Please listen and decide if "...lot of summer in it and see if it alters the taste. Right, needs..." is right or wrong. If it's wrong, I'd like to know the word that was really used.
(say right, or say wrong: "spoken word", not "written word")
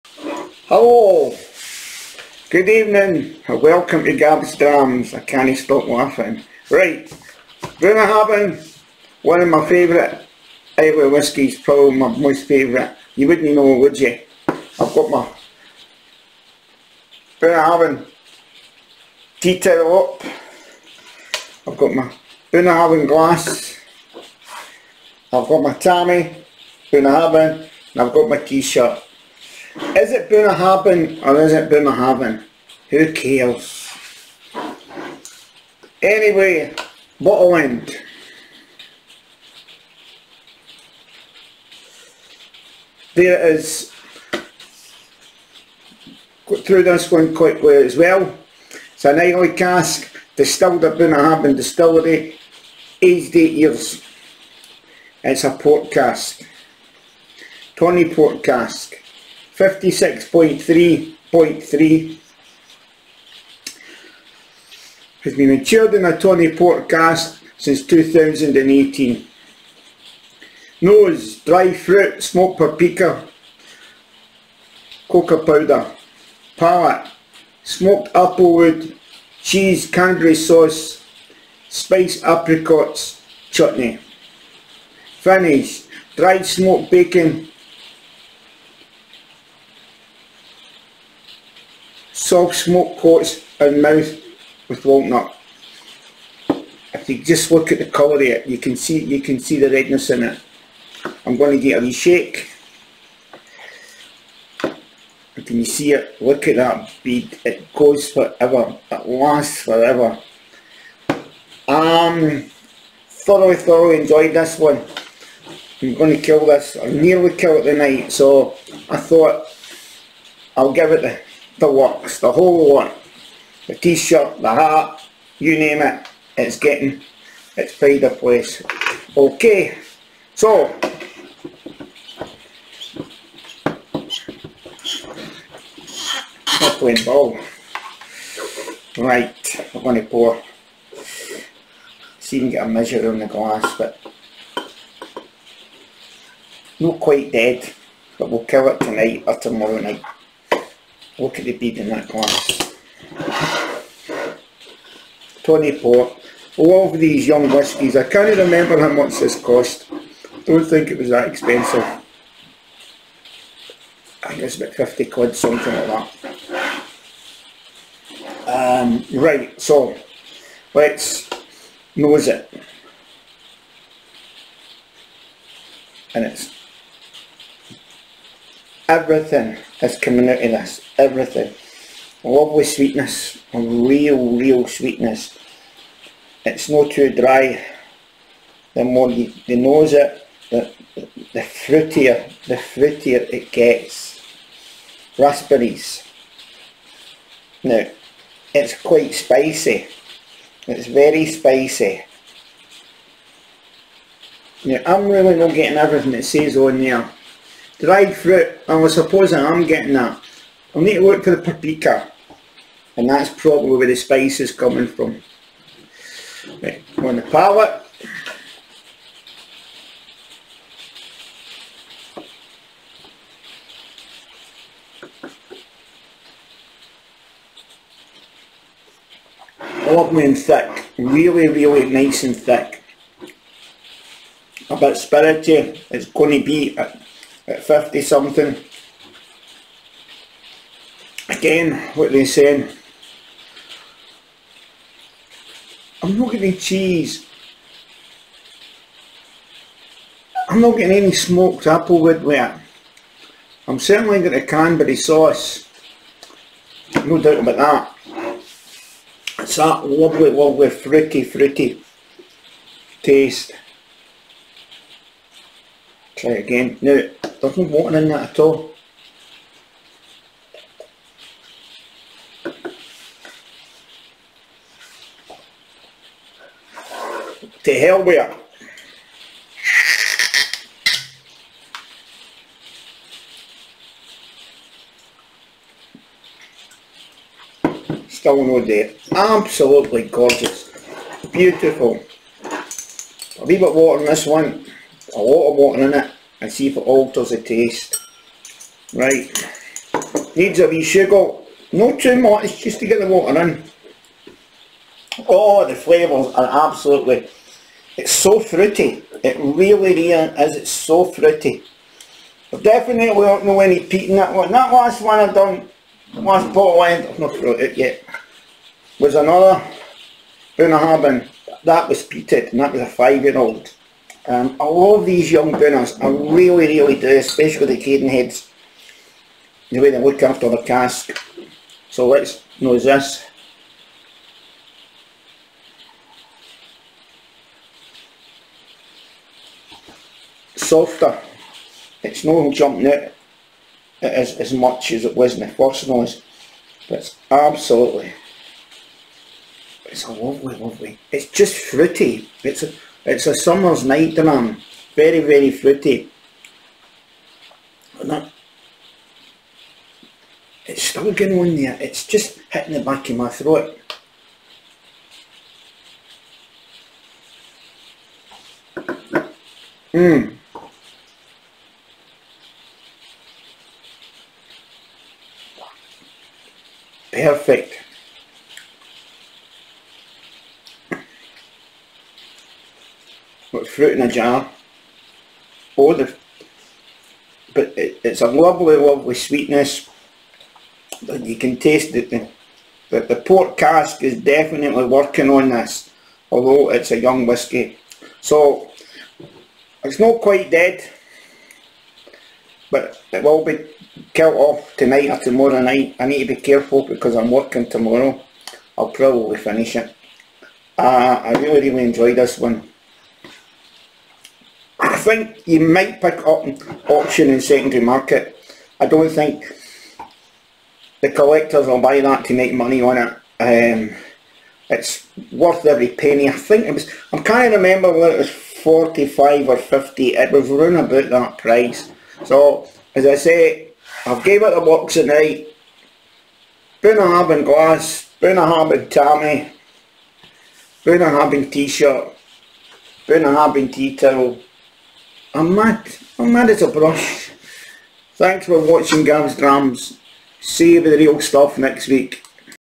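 wrong: "water", not "summer".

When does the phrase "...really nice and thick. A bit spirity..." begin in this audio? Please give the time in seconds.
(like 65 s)
231 s.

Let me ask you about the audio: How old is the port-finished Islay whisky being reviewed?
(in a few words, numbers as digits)
8 years.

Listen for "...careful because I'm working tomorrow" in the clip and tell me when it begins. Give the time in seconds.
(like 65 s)
406 s.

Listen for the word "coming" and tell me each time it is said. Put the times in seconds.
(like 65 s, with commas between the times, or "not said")
179 s, 214 s.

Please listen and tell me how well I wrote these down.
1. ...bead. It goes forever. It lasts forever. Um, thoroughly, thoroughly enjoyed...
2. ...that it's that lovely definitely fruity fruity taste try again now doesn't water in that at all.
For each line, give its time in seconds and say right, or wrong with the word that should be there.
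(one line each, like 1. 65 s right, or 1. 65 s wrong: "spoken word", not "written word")
1. 107 s right
2. 257 s wrong: "lovely", not "definitely".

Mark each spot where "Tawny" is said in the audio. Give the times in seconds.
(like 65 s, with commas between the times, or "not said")
57 s, 66 s.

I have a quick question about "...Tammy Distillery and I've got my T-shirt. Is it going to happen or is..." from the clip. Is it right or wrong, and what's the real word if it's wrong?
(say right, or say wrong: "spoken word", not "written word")
wrong: "Bunnahabhain", not "Distillery".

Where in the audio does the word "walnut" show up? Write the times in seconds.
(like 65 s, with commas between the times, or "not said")
94 s.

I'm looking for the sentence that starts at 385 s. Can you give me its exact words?
or the, but it, it's a lovely, lovely sweetness.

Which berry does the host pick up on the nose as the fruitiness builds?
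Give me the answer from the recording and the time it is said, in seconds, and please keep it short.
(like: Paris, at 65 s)
Raspberries, at 195 s.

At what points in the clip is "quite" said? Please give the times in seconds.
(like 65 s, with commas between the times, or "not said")
47 s, 146 s, 198 s, 400 s.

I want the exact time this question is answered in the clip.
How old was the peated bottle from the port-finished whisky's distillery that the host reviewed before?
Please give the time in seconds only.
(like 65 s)
322 s.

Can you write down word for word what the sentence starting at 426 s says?
I think it was, I'm not remember whether it was 45 or 50.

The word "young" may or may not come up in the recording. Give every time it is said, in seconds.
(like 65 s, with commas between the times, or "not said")
157 s, 325 s, 396 s.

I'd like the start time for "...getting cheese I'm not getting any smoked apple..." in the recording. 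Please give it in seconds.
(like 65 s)
246 s.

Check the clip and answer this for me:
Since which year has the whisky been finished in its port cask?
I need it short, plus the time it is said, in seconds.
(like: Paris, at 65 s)
2018, at 67 s.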